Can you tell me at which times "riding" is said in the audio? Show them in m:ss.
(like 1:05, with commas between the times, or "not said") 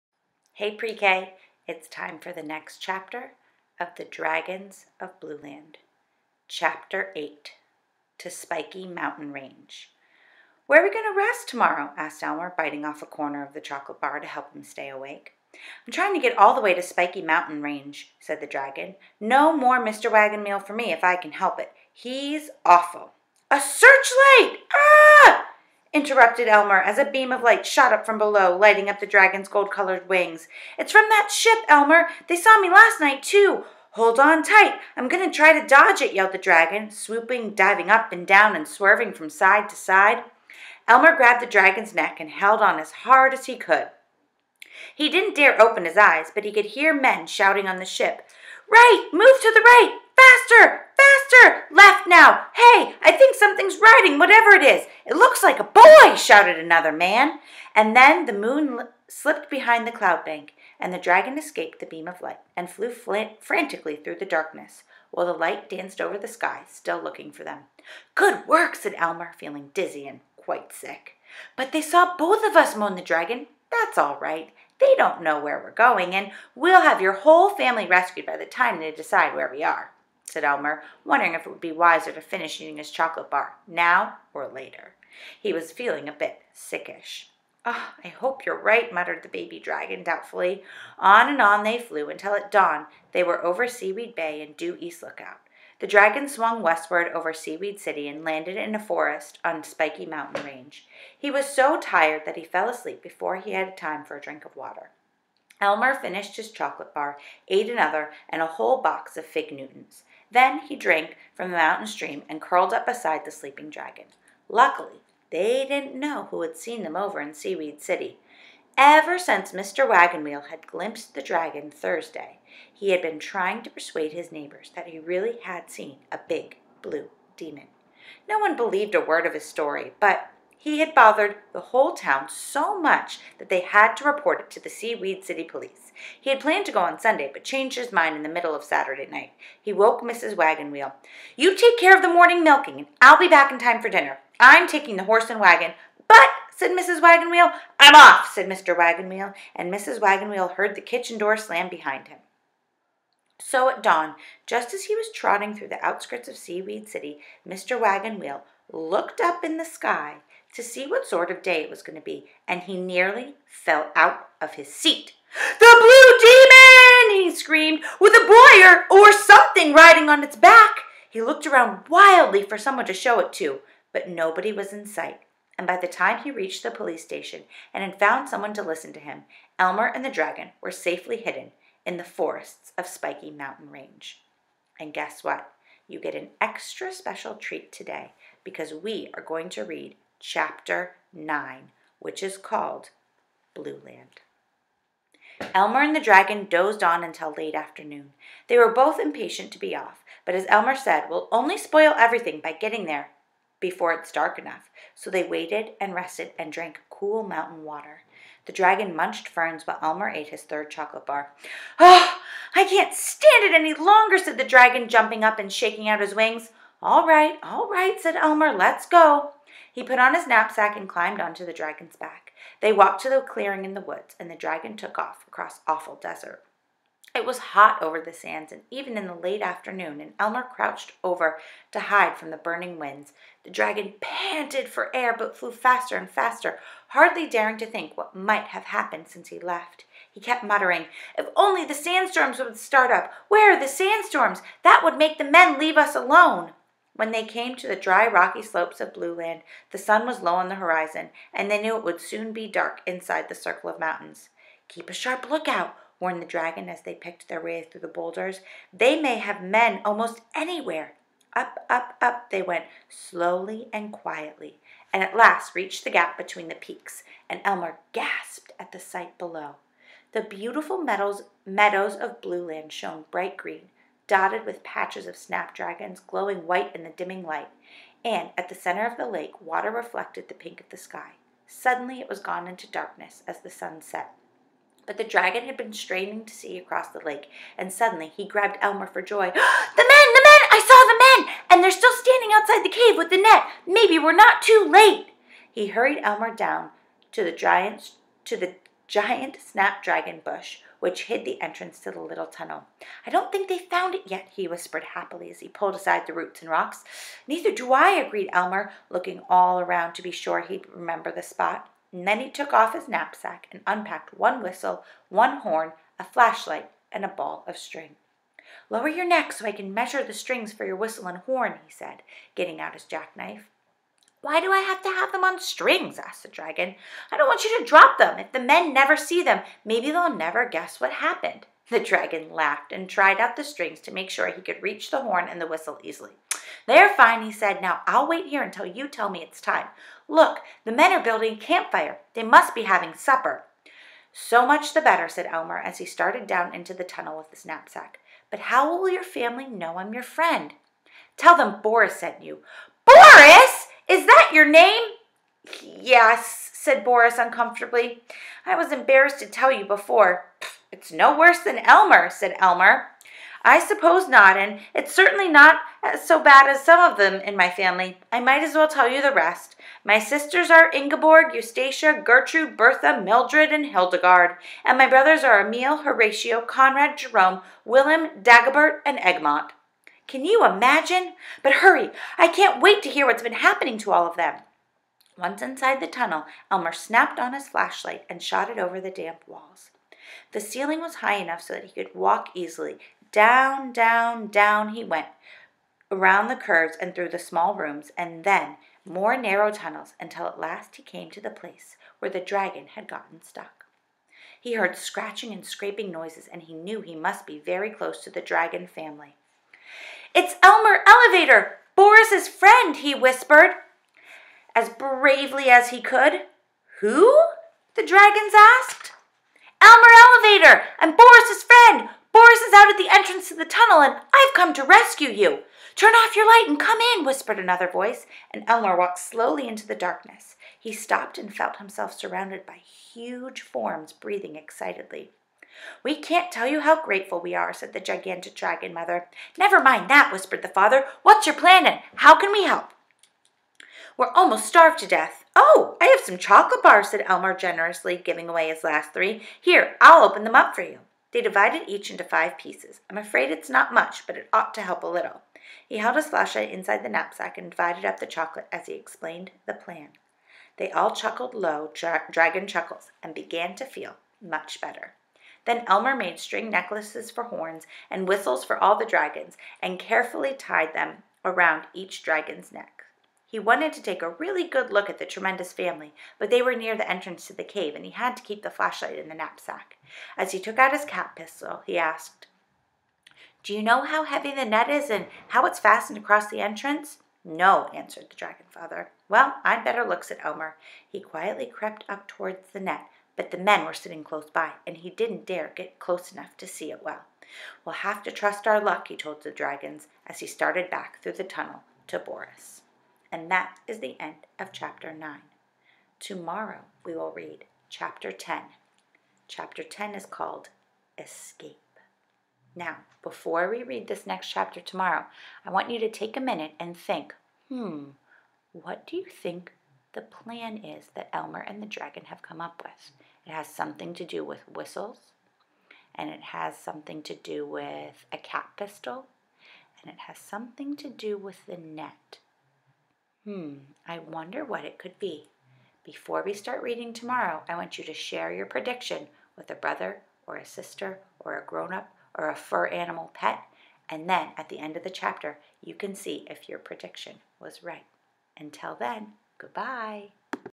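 0:53, 2:49.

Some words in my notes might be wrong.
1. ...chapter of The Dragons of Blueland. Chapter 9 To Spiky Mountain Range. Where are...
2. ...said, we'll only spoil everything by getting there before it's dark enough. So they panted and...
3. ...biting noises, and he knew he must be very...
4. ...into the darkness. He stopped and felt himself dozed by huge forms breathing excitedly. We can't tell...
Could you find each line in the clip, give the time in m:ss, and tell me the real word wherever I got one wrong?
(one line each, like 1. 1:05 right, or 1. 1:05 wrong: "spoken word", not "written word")
1. 0:02 wrong: "8", not "9"
2. 3:20 wrong: "waited", not "panted"
3. 6:45 wrong: "scraping", not "biting"
4. 7:09 wrong: "surrounded", not "dozed".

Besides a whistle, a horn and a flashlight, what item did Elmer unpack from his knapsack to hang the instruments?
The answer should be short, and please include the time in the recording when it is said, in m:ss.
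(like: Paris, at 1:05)
A ball of string, at 5:17.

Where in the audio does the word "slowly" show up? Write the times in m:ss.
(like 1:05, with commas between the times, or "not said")
4:22, 7:08.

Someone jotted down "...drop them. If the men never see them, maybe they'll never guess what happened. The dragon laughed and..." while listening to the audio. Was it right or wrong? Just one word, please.
right.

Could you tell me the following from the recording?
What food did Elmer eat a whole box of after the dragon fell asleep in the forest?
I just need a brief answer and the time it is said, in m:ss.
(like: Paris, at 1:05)
Fig Newtons, at 1:49.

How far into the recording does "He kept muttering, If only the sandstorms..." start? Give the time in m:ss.
4:00.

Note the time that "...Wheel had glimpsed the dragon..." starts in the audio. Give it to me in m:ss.
2:00.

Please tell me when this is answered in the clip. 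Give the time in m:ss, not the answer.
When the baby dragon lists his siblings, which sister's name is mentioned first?
6:10.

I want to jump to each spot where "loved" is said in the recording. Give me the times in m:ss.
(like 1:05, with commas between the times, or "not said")
not said.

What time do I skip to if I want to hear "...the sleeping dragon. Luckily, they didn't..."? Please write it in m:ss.
1:53.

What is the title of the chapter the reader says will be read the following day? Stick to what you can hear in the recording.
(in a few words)
Escape.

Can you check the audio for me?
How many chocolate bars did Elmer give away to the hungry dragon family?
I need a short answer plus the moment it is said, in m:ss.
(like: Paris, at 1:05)
3, at 7:28.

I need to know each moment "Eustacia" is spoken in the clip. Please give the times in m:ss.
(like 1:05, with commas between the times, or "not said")
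6:11.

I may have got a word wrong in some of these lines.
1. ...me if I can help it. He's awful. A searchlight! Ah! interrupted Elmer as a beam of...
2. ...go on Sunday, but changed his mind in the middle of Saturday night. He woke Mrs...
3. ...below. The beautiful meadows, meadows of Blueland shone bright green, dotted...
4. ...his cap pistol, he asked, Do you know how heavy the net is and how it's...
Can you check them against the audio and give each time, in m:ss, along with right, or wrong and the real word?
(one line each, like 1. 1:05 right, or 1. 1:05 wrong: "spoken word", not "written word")
1. 0:20 right
2. 2:16 right
3. 4:29 right
4. 8:00 right.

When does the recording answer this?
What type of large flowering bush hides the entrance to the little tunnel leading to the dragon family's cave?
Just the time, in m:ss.
4:59.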